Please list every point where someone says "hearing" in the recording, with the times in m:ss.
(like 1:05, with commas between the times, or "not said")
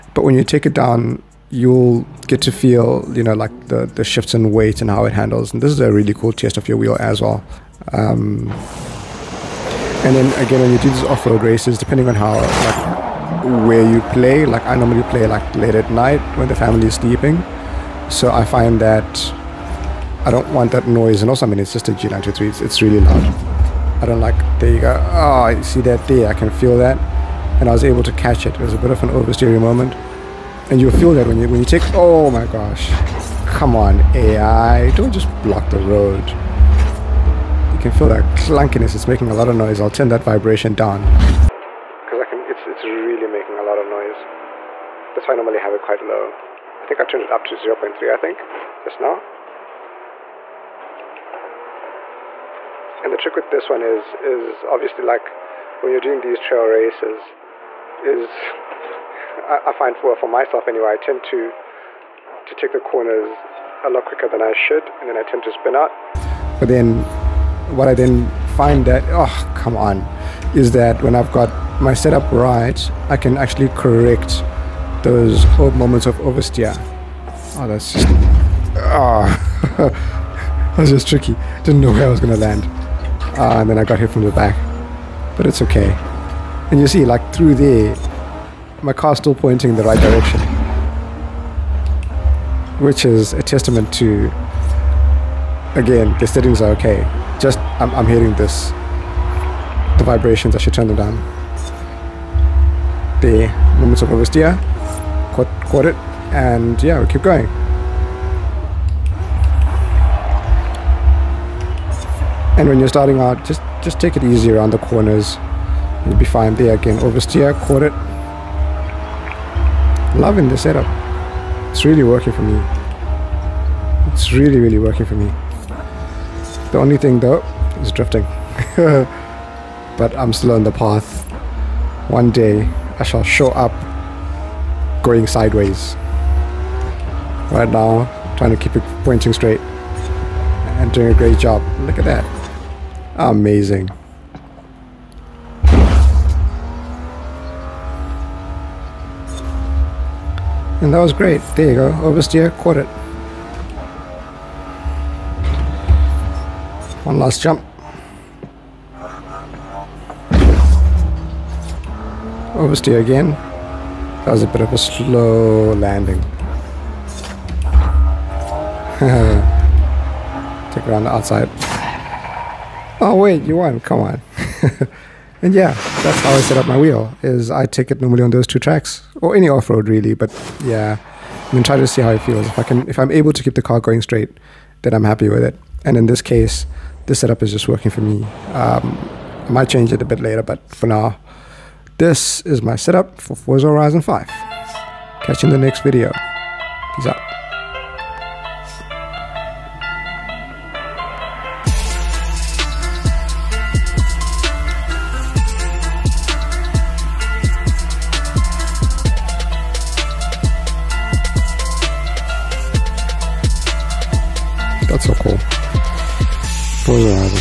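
1:38.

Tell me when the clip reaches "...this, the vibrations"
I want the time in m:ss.
1:38.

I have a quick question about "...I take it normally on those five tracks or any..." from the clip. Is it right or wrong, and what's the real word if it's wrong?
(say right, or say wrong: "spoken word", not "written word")
wrong: "two", not "five".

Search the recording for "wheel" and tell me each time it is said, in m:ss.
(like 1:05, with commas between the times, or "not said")
0:06, 2:56.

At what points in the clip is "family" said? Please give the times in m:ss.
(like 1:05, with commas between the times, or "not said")
0:16.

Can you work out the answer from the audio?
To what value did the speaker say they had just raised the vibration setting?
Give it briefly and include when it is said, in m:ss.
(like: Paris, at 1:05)
0.3, at 0:47.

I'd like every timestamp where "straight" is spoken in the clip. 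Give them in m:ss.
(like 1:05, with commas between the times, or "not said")
2:19, 3:04.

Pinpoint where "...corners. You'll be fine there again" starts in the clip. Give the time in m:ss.
1:54.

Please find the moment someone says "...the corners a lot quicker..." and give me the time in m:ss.
1:02.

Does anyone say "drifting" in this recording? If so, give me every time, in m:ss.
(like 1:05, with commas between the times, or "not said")
2:07.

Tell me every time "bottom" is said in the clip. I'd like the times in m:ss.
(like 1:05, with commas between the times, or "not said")
not said.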